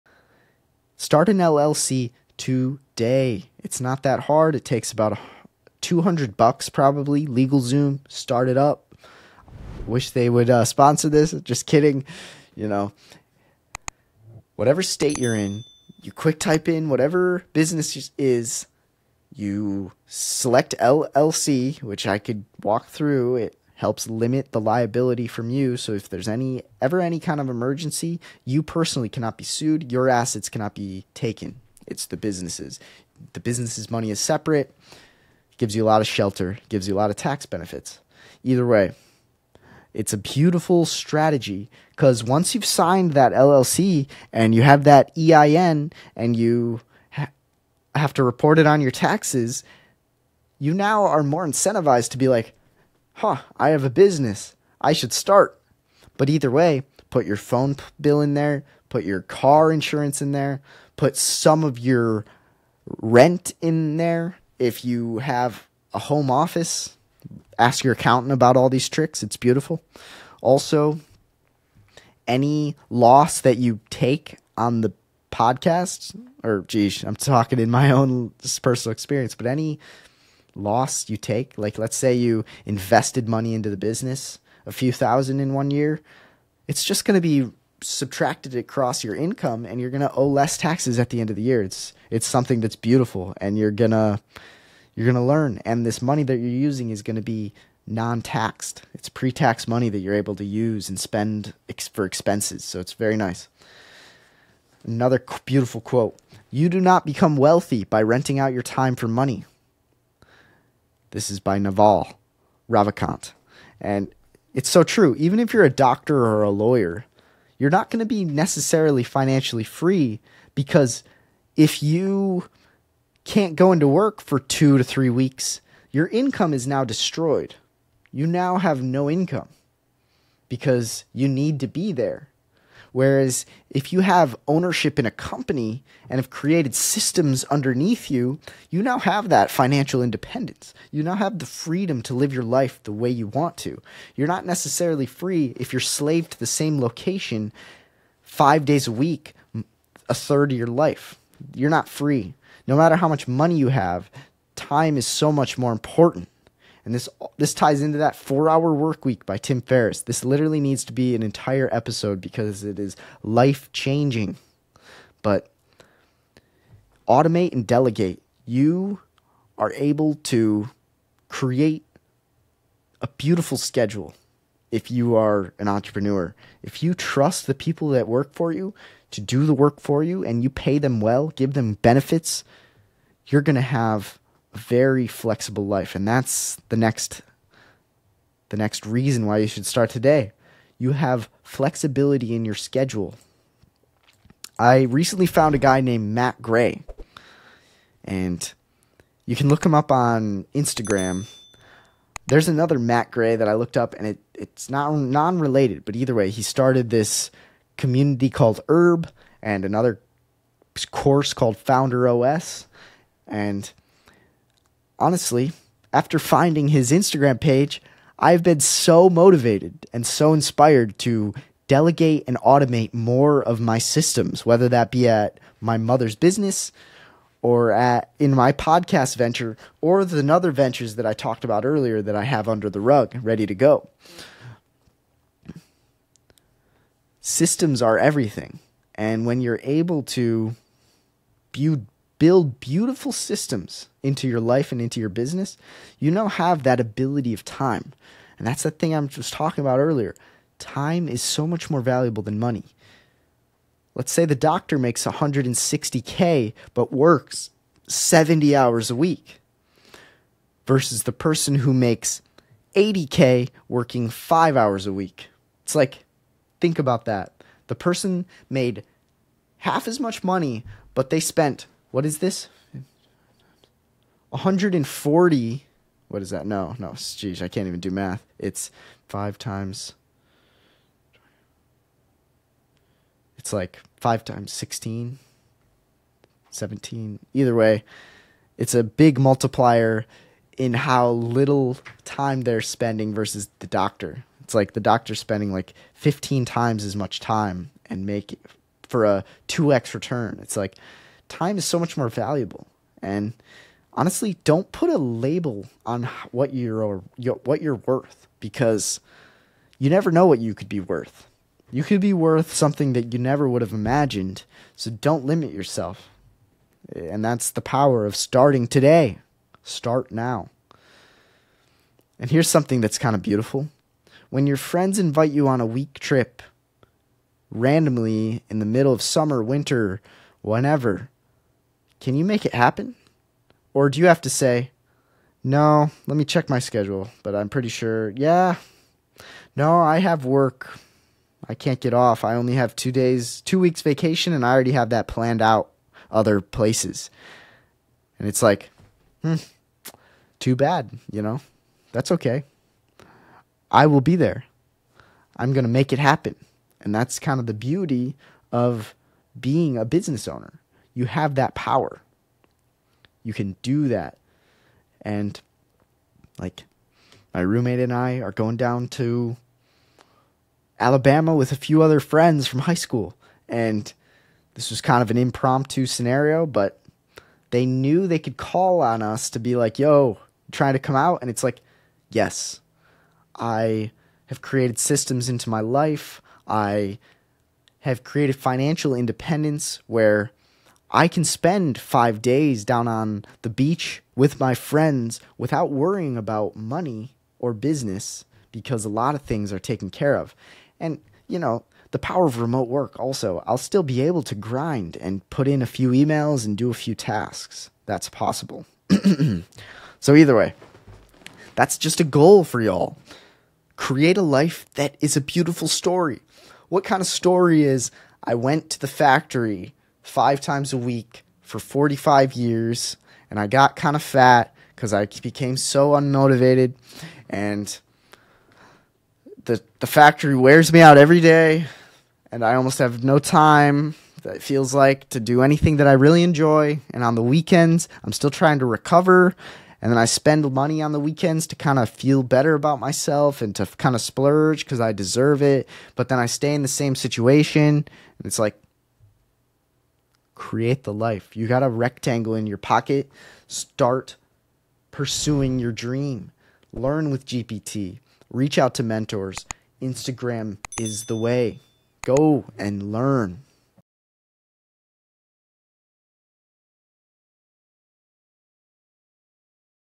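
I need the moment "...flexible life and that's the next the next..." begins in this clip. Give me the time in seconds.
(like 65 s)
185 s.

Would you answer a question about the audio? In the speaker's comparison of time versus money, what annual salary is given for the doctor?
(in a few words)
160K.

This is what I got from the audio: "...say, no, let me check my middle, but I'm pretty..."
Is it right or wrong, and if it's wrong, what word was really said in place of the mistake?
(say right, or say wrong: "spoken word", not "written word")
wrong: "schedule", not "middle".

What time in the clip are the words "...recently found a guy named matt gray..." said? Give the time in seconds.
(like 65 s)
194 s.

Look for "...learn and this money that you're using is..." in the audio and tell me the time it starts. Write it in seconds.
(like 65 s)
95 s.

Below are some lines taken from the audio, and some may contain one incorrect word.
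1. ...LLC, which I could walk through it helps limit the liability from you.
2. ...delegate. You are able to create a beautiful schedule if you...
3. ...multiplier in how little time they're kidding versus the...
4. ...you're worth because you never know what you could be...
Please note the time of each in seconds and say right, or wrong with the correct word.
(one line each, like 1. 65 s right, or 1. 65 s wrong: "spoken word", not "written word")
1. 20 s right
2. 167 s right
3. 289 s wrong: "spending", not "kidding"
4. 307 s right.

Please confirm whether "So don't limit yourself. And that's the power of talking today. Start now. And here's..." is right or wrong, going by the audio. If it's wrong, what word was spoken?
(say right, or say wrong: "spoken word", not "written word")
wrong: "starting", not "talking".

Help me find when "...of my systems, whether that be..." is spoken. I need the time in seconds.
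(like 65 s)
223 s.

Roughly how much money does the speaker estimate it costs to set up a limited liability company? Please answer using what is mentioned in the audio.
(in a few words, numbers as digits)
$200.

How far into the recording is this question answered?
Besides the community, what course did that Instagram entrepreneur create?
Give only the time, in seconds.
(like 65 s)
211 s.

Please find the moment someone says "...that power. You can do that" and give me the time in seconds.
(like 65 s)
361 s.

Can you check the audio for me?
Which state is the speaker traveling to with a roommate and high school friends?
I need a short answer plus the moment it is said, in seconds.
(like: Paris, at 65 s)
Alabama, at 370 s.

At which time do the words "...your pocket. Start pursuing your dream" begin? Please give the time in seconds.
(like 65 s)
452 s.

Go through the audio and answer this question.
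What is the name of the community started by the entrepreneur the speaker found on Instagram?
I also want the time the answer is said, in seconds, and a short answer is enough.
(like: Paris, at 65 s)
Herd, at 208 s.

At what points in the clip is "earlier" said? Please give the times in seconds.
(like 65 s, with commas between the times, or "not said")
231 s, 249 s.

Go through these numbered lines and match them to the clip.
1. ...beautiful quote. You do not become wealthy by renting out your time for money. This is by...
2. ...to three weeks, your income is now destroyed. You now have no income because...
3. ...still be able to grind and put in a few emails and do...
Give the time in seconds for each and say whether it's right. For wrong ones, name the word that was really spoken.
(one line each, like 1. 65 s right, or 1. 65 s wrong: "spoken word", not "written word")
1. 105 s right
2. 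124 s right
3. 403 s right.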